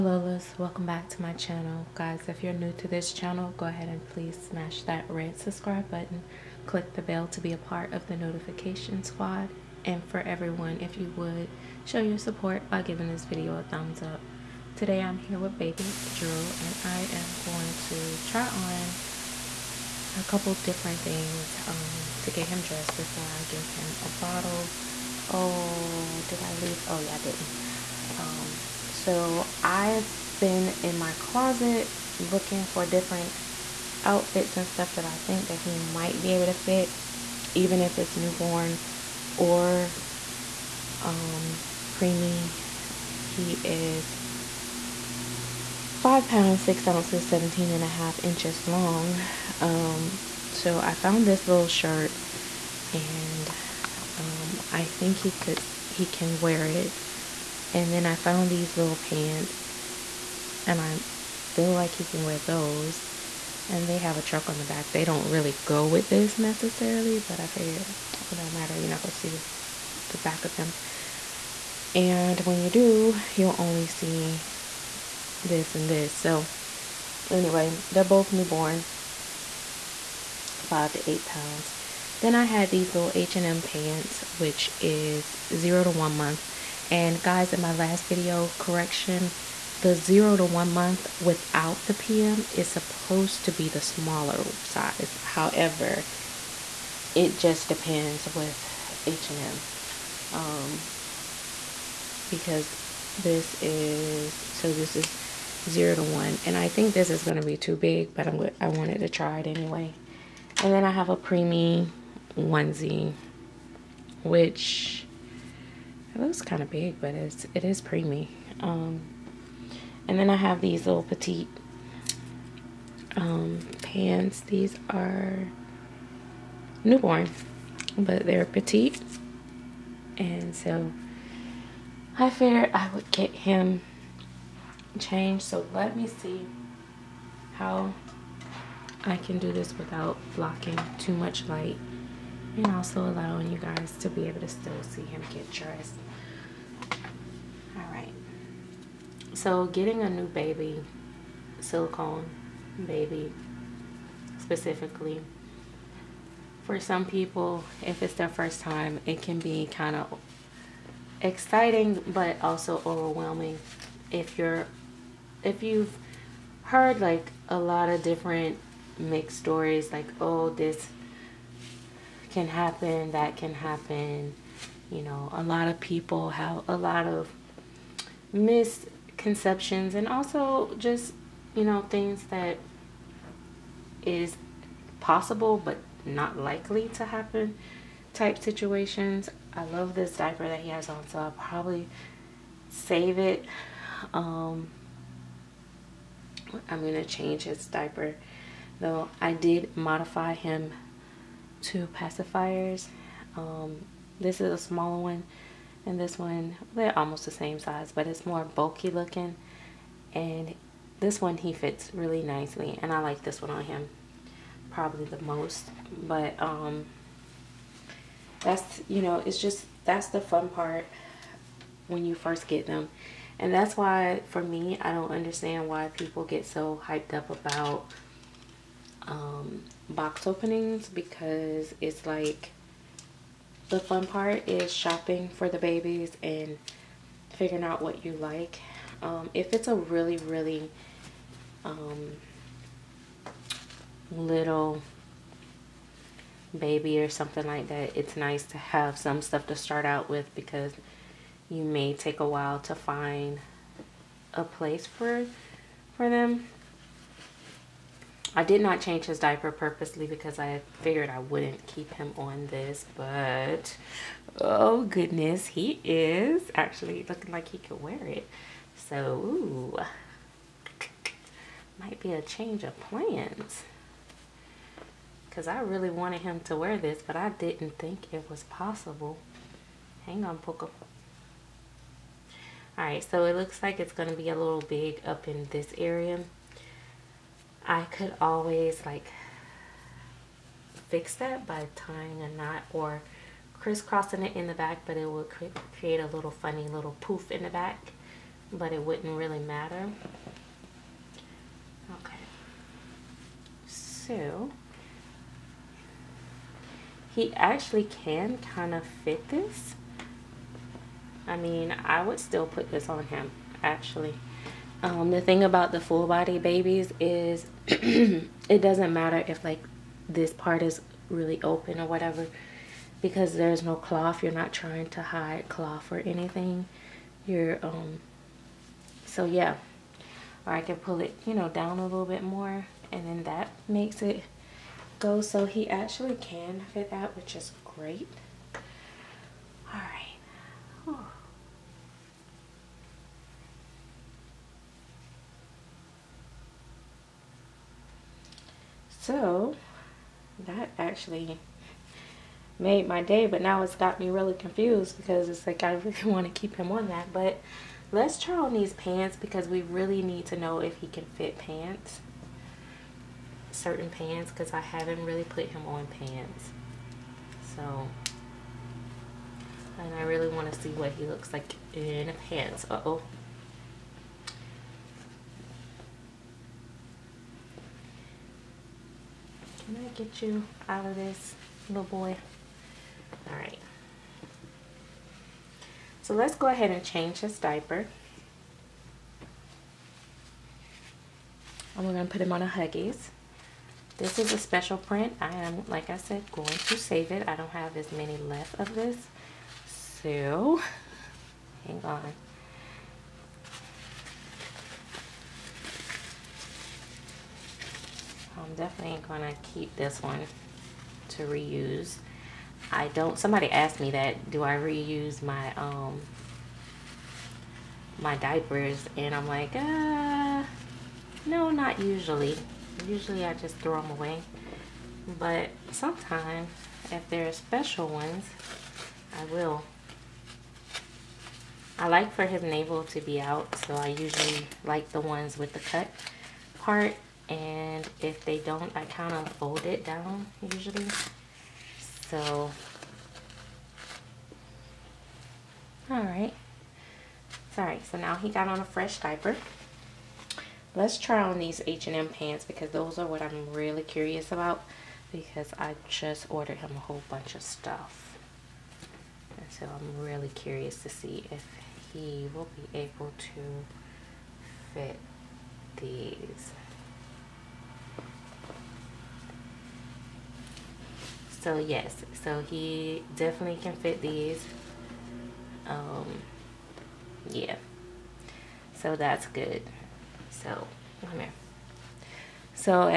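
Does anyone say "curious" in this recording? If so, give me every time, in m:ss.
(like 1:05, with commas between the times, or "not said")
7:33, 7:40.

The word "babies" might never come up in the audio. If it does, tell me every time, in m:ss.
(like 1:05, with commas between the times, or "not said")
3:55, 5:16.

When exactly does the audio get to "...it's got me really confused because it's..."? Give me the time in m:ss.
5:53.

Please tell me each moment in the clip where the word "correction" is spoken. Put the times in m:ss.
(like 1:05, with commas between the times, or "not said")
1:28.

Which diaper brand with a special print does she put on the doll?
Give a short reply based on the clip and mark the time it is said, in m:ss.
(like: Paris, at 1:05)
Huggies, at 6:32.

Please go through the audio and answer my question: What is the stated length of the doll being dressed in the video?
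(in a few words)
17 and a half inches.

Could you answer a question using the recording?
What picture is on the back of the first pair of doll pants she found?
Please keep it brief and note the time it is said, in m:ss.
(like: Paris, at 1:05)
a truck, at 1:04.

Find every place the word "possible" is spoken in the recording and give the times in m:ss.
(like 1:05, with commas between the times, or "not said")
3:04, 4:38.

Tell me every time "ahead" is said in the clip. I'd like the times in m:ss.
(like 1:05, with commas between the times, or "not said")
0:03, 6:26.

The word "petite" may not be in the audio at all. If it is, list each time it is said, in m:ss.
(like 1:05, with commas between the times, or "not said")
2:01, 2:08.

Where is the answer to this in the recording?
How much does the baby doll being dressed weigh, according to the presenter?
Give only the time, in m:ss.
0:45.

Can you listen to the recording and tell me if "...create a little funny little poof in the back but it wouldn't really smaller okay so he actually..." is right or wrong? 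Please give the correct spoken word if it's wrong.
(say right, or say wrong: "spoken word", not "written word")
wrong: "matter", not "smaller".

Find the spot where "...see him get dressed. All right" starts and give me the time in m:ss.
2:24.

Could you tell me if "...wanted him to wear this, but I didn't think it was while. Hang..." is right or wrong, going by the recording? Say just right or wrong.
wrong.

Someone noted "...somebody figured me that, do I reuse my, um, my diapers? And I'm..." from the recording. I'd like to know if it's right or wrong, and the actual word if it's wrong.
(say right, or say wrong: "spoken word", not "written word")
wrong: "asked", not "figured".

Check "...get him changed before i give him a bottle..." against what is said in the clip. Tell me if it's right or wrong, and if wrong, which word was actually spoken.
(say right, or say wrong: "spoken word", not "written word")
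wrong: "dressed", not "changed".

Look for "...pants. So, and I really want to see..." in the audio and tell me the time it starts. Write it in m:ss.
6:05.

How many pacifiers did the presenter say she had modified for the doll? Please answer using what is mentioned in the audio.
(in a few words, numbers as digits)
2.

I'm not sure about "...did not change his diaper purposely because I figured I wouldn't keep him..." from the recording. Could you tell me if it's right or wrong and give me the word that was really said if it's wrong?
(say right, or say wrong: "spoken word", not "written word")
right.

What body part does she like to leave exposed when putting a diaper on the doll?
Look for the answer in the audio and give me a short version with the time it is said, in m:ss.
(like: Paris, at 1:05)
navel, at 7:12.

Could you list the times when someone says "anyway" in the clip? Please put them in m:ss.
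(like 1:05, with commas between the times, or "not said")
1:17, 1:49.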